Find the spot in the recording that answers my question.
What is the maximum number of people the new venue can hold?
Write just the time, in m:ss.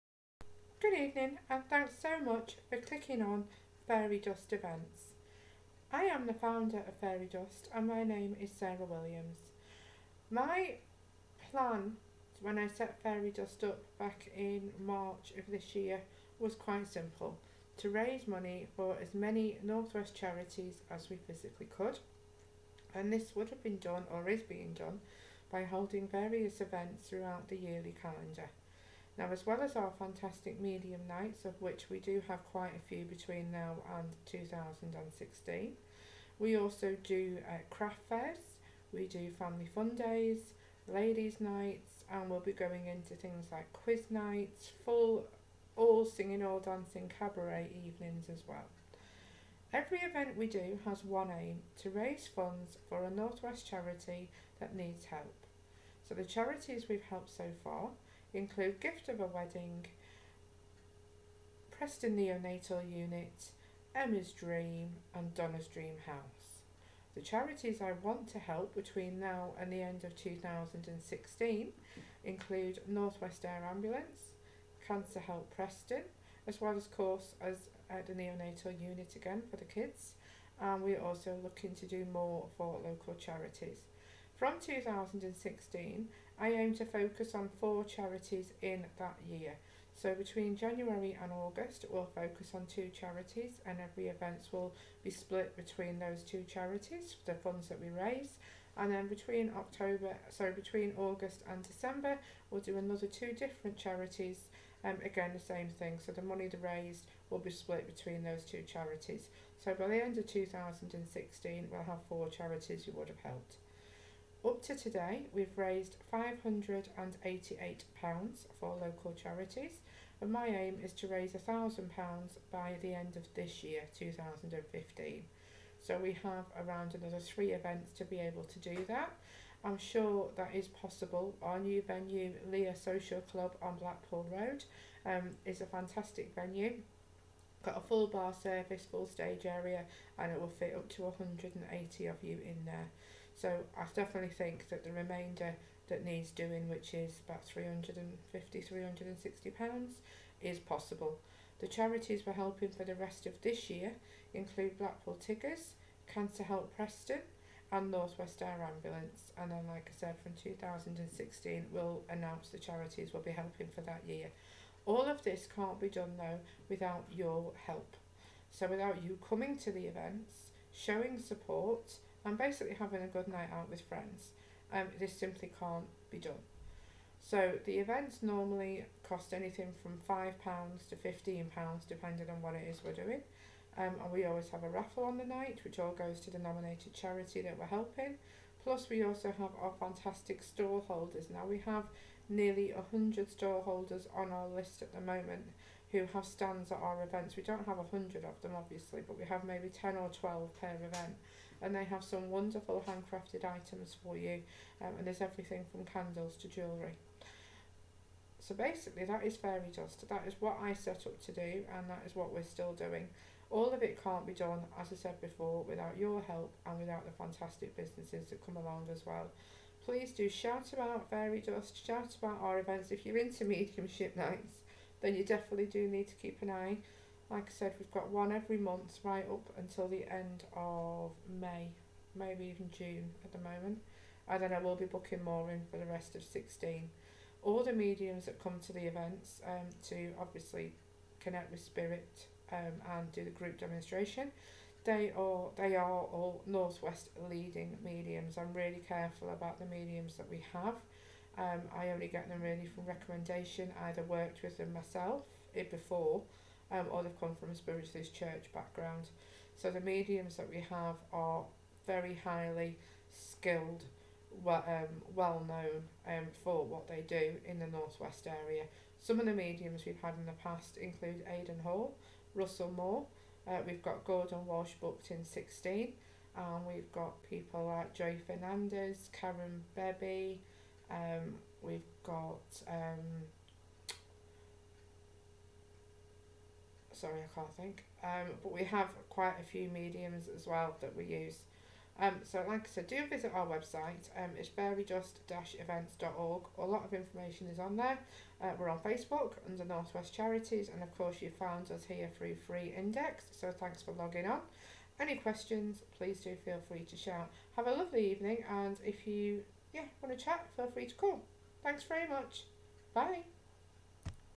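2:21.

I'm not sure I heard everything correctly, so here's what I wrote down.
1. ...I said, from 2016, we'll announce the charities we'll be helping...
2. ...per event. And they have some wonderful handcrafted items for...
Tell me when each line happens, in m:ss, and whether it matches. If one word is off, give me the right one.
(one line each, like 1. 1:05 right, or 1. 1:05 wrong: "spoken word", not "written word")
1. 2:39 right
2. 3:20 right.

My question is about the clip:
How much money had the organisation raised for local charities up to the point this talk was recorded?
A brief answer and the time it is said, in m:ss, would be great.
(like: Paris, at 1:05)
£588, at 1:56.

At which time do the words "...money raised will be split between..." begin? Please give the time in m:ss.
1:46.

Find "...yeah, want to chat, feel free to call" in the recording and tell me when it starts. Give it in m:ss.
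5:09.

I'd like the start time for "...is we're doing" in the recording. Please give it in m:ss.
3:02.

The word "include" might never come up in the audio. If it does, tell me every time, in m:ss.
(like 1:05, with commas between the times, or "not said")
0:58, 1:12, 2:34, 4:30.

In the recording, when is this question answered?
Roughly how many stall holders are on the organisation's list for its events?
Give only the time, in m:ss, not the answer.
3:12.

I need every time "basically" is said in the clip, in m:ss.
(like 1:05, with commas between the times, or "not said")
2:52, 3:28.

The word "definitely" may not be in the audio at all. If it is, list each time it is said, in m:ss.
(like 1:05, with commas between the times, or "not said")
2:23, 3:45.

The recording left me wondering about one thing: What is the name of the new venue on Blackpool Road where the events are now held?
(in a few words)
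Leah Social Club.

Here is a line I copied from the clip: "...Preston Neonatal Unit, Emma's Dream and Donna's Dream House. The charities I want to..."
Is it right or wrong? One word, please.
right.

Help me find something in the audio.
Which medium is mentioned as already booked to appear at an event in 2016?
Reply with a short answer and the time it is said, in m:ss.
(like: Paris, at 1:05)
Gordon Walsh, at 4:34.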